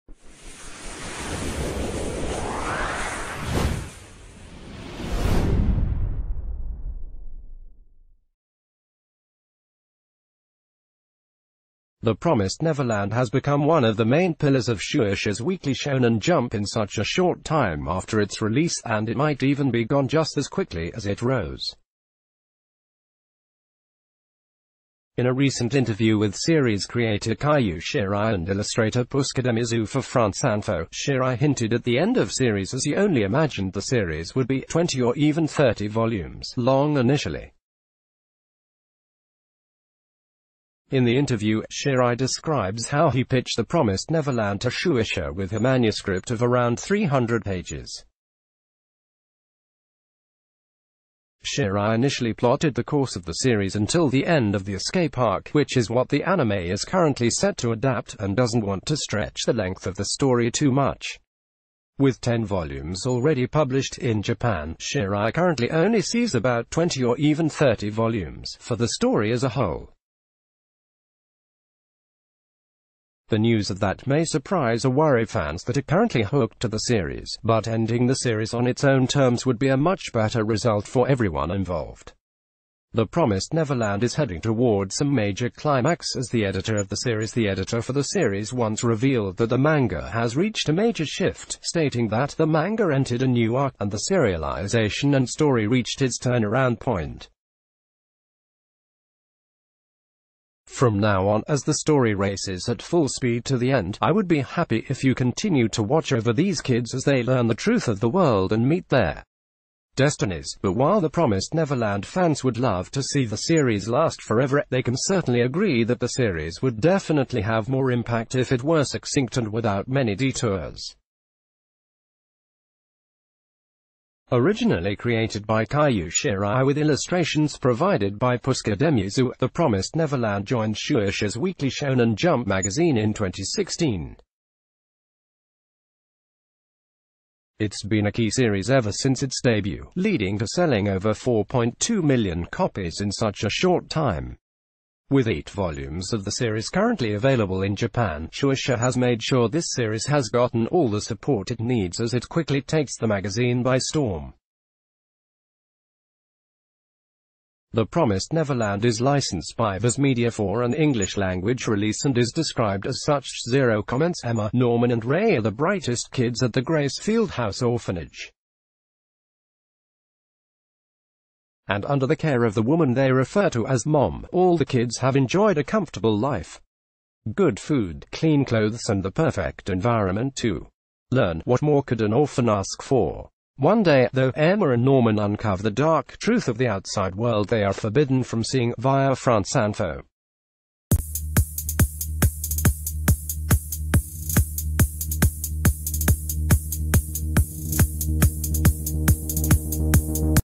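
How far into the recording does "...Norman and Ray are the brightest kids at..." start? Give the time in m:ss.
2:44.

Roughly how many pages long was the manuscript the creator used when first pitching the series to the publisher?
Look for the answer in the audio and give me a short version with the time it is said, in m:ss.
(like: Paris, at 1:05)
300, at 0:46.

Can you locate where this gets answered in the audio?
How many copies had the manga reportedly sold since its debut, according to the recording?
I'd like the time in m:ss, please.
2:21.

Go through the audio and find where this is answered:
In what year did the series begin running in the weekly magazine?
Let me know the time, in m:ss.
2:13.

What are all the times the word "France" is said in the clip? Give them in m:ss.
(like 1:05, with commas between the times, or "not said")
0:30, 3:09.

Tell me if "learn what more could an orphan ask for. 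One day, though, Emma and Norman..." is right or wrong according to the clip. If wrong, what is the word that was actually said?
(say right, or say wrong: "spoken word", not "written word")
right.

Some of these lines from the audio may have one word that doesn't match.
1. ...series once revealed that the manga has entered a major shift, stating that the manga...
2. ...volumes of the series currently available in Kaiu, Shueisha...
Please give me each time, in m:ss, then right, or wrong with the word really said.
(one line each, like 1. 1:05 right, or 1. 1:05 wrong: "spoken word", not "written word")
1. 1:28 wrong: "reached", not "entered"
2. 2:25 wrong: "Japan", not "Kaiu".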